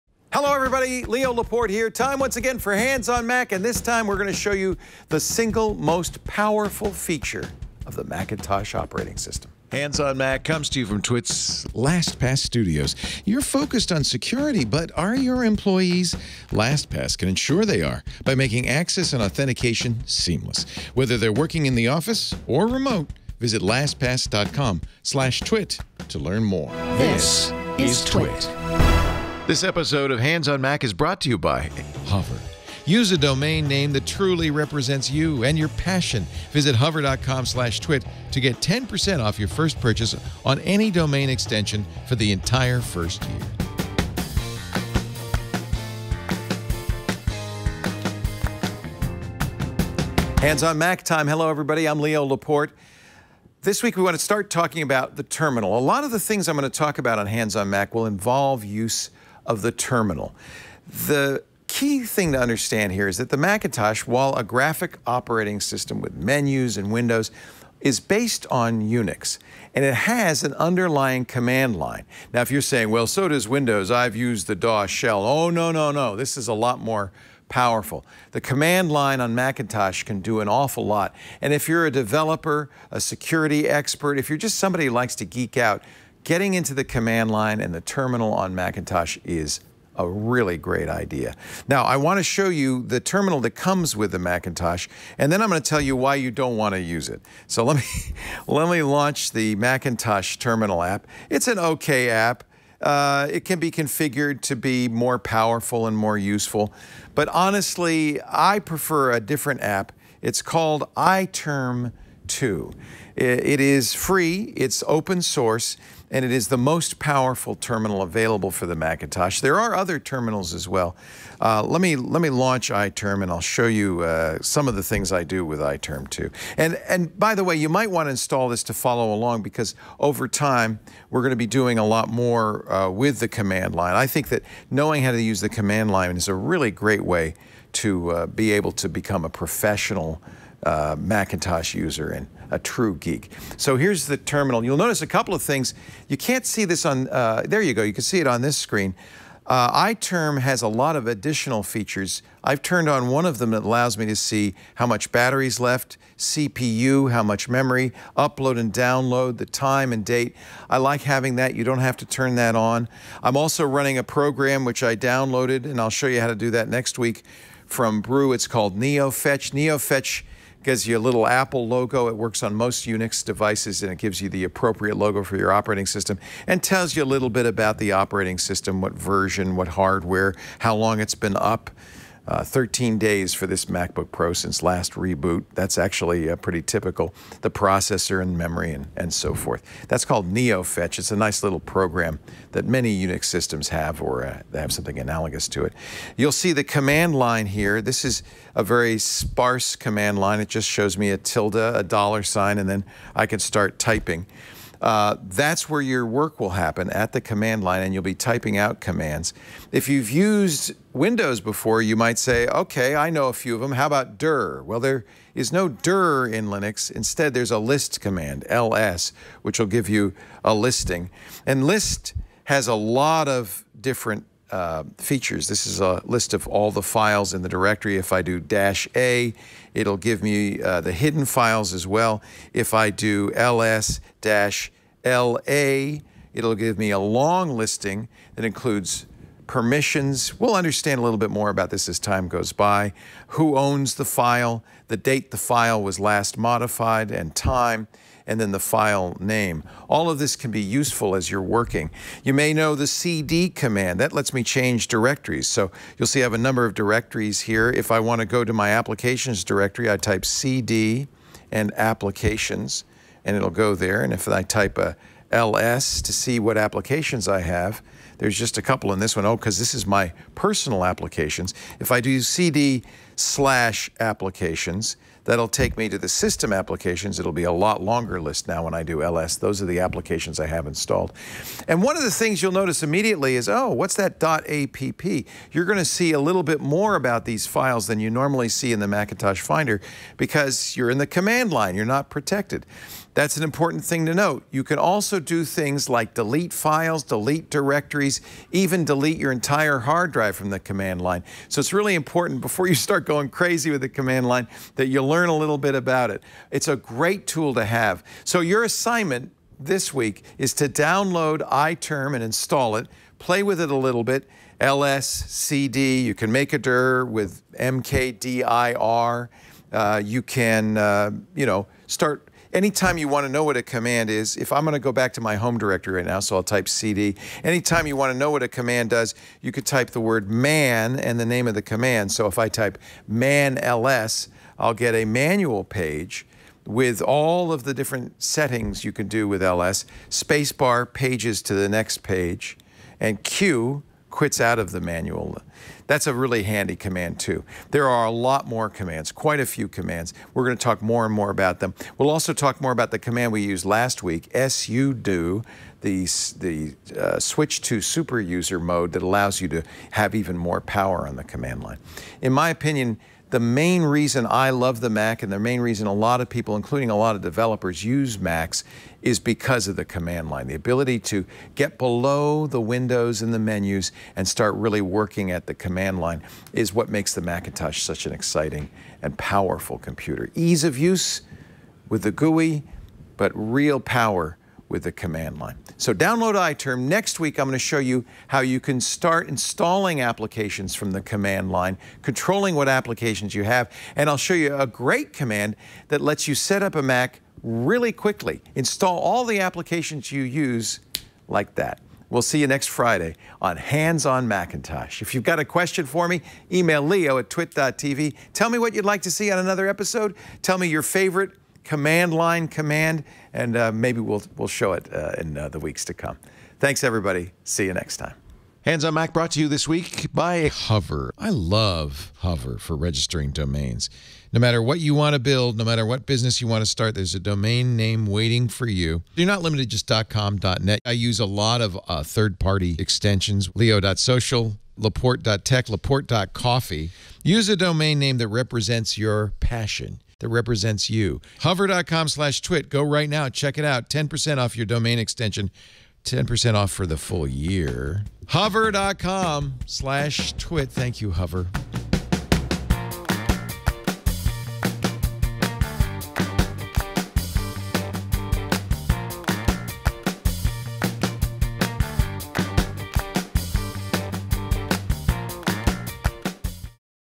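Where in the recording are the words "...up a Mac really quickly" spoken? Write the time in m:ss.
6:36.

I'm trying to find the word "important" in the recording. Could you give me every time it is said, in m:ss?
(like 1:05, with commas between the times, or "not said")
4:53, 5:01.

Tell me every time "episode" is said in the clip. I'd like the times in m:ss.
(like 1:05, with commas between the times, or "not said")
0:29, 6:49.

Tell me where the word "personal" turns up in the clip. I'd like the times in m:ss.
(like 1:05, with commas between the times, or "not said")
4:30.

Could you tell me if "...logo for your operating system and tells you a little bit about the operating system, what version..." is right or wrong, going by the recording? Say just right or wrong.
right.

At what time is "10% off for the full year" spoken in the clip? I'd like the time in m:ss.
7:26.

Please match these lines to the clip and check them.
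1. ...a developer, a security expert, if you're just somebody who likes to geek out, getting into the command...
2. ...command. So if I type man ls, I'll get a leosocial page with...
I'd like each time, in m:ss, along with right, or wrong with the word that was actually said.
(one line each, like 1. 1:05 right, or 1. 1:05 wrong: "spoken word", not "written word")
1. 1:21 right
2. 5:31 wrong: "manual", not "leosocial".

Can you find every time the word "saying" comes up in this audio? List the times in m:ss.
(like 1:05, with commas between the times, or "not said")
1:12.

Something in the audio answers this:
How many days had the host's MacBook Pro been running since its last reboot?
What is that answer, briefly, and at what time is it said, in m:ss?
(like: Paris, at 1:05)
13, at 3:02.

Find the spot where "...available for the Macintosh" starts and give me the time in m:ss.
1:58.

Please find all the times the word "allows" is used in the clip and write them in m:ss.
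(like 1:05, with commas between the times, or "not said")
2:33, 5:59.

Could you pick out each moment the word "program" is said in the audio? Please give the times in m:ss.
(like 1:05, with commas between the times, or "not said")
2:44, 3:11.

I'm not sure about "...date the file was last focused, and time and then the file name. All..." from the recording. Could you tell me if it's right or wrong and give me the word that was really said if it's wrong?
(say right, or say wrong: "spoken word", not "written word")
wrong: "modified", not "focused".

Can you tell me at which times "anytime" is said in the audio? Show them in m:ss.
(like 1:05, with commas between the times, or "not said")
5:22, 5:27.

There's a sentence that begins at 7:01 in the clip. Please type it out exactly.
I love Hover for registering domains.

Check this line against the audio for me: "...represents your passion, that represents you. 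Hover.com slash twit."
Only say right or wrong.
right.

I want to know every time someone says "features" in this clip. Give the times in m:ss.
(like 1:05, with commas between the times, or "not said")
0:06, 2:31, 3:44.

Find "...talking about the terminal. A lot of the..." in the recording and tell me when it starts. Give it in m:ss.
0:54.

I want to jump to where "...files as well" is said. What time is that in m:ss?
3:51.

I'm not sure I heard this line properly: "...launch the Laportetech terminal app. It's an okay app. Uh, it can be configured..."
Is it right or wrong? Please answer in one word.
wrong.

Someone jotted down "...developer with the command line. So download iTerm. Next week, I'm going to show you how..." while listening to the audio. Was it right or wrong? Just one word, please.
wrong.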